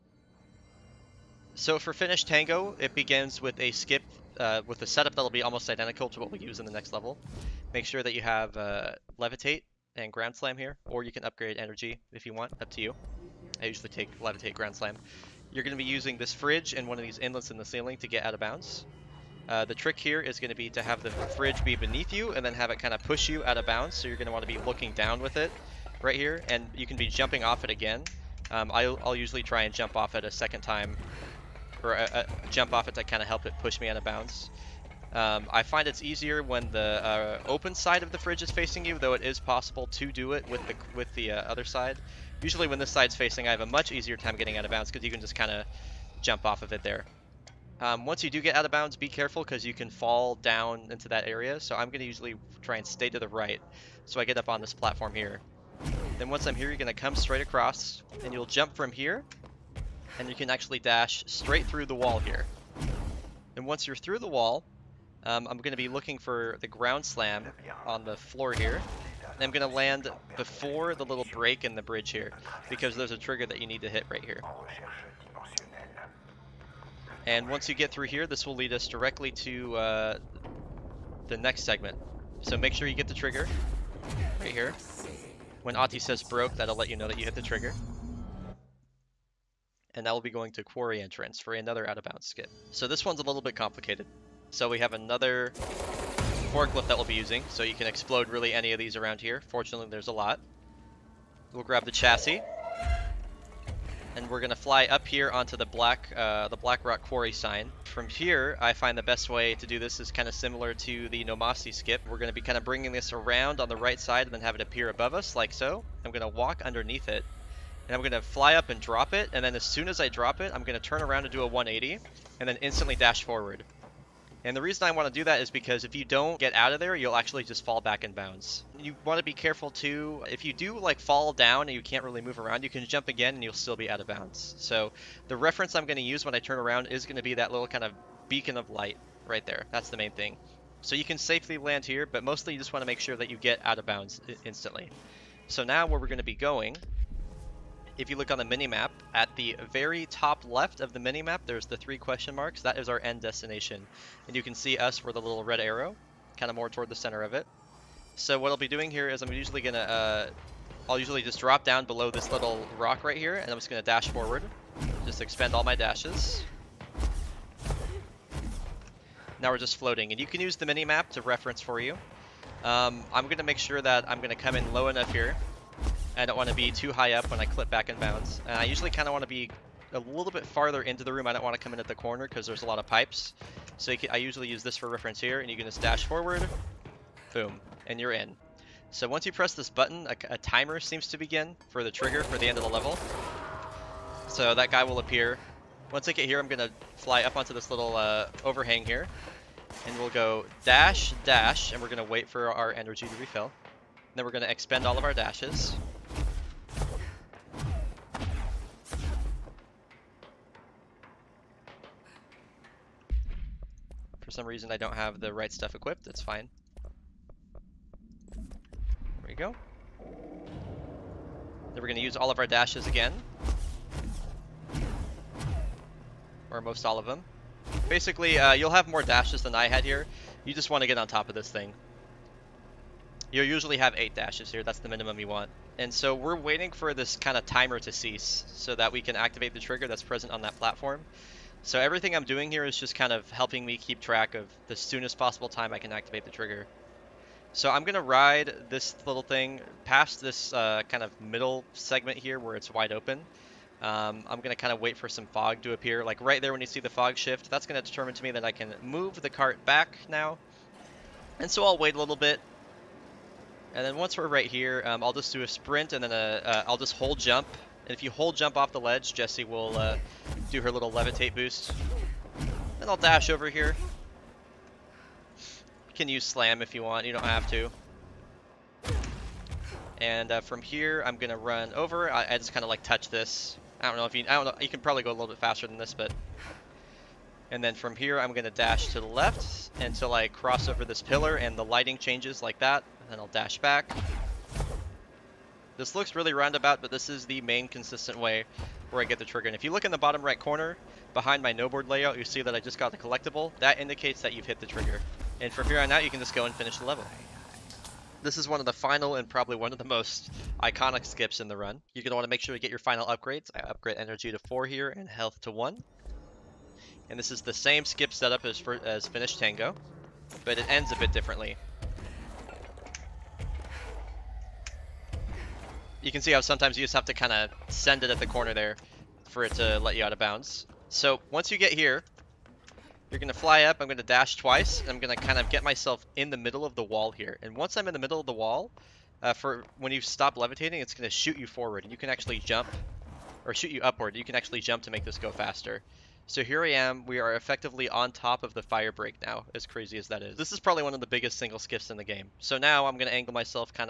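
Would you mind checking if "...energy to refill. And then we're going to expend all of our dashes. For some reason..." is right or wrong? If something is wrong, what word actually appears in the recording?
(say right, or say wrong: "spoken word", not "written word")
right.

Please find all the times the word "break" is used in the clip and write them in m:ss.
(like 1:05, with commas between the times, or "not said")
1:11, 5:48.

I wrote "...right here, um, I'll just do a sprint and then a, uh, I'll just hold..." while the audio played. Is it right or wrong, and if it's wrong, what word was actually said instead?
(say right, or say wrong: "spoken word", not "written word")
right.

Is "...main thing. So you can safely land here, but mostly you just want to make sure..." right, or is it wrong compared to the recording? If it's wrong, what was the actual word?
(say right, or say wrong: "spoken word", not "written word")
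right.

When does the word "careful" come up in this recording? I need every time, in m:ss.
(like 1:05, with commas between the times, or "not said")
0:49, 2:09.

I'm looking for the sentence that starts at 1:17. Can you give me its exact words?
And once you get through here, this will lead us directly to uh, the next segment.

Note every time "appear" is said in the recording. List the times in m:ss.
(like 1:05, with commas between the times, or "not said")
1:54, 3:14, 4:15.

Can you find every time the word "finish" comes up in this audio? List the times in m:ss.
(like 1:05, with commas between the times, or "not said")
0:01, 5:06, 5:19.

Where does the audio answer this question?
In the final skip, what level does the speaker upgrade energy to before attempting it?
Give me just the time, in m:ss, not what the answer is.
5:14.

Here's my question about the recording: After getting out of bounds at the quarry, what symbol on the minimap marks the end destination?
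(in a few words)
three question marks.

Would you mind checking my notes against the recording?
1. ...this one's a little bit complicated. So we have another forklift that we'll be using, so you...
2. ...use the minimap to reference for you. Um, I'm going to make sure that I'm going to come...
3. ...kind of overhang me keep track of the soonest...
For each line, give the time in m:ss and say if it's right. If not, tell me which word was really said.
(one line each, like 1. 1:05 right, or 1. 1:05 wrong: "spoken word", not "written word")
1. 1:32 right
2. 2:50 right
3. 4:02 wrong: "helping", not "overhang".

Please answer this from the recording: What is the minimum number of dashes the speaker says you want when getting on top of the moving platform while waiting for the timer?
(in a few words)
8.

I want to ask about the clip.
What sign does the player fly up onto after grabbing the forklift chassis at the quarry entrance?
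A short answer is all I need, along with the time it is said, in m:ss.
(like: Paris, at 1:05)
Black Rock Quarry sign, at 1:46.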